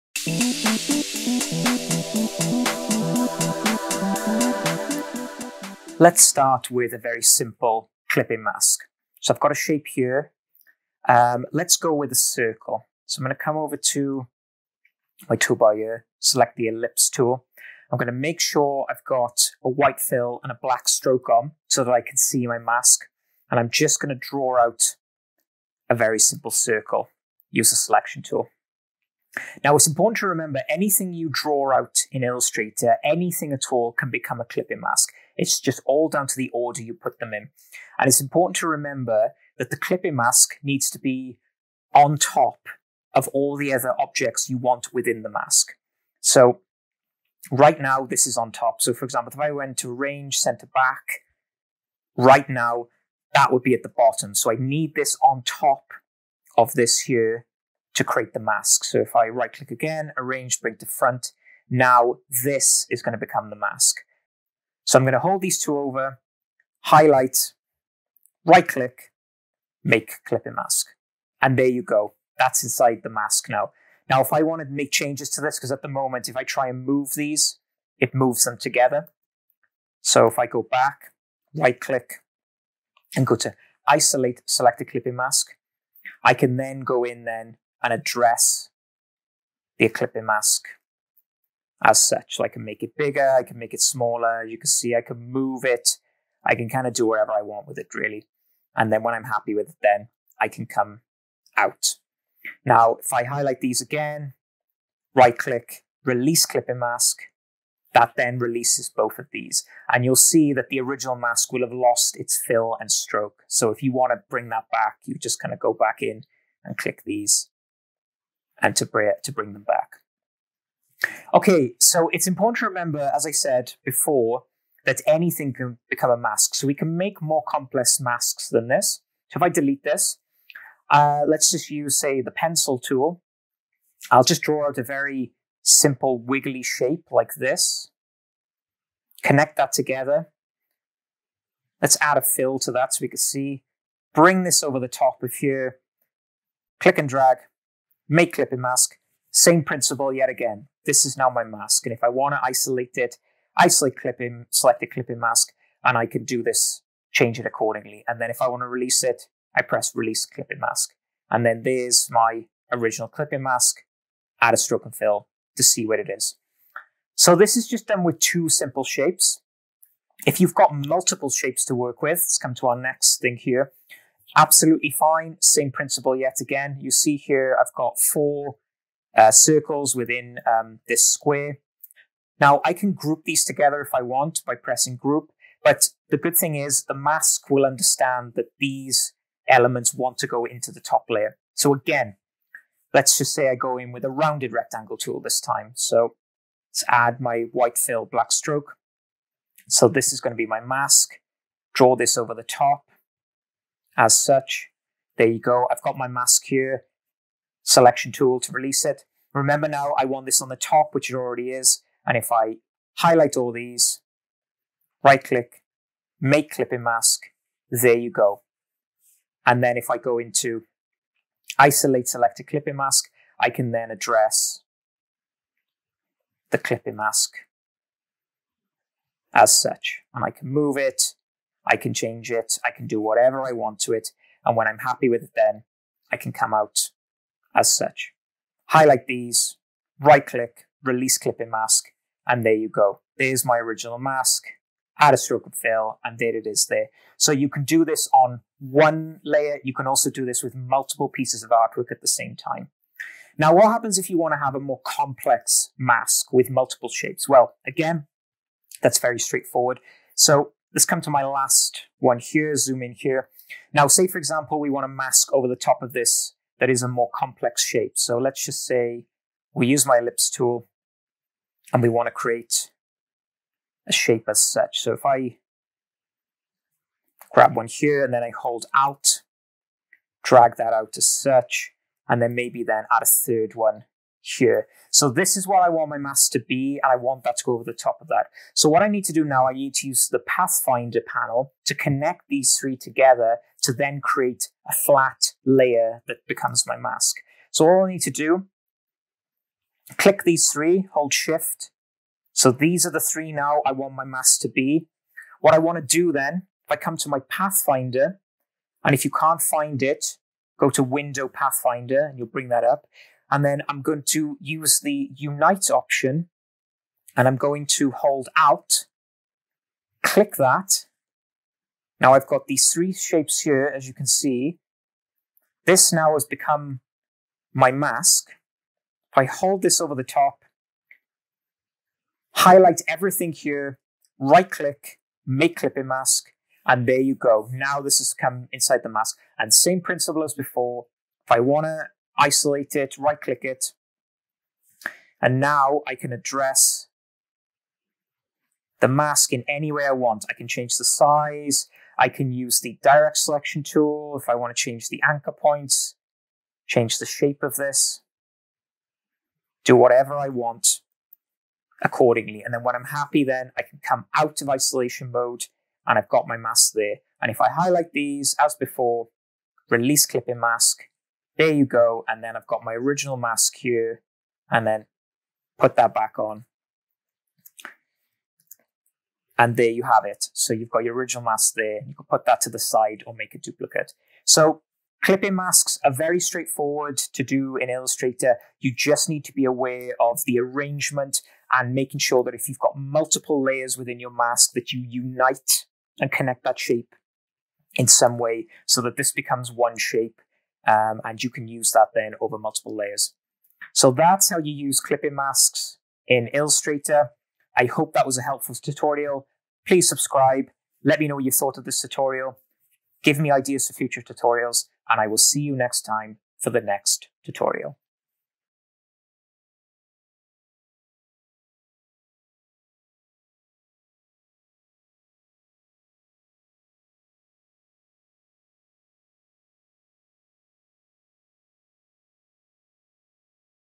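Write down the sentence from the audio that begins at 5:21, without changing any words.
Now I've got these three shapes here, as you can see.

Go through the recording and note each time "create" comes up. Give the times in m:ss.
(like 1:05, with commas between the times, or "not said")
0:58, 4:32, 4:54.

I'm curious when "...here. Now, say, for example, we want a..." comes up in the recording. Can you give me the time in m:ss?
4:22.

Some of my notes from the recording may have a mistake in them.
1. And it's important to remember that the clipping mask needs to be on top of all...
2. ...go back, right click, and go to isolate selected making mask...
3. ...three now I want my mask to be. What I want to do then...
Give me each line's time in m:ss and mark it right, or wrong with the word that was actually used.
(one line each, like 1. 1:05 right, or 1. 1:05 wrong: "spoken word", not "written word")
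1. 0:37 right
2. 1:20 wrong: "clipping", not "making"
3. 5:02 right.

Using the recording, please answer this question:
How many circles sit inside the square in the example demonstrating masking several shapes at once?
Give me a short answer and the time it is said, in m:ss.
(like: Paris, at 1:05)
4, at 2:57.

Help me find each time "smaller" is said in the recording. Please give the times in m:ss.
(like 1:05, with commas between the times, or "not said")
1:33.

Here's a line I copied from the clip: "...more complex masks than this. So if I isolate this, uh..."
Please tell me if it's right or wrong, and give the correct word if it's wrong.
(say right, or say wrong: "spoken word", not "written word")
wrong: "delete", not "isolate".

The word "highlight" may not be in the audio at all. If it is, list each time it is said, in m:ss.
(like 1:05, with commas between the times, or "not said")
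1:06, 1:43, 3:32, 3:58, 5:32, 6:07.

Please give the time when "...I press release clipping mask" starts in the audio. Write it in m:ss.
2:39.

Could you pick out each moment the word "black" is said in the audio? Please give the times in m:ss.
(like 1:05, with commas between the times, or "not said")
0:20, 3:18.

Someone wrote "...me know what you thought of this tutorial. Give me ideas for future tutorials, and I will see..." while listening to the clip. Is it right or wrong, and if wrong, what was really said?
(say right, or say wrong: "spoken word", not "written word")
right.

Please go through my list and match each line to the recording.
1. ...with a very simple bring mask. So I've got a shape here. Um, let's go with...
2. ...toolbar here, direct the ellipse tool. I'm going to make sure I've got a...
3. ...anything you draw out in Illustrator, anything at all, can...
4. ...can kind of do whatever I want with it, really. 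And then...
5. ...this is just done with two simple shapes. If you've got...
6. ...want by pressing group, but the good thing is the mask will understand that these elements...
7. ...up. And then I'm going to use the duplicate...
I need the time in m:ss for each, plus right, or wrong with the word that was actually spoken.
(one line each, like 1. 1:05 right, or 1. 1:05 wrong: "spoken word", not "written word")
1. 0:06 wrong: "clipping", not "bring"
2. 0:15 wrong: "select", not "direct"
3. 0:30 right
4. 1:36 right
5. 2:47 right
6. 3:04 right
7. 5:12 wrong: "unite", not "duplicate".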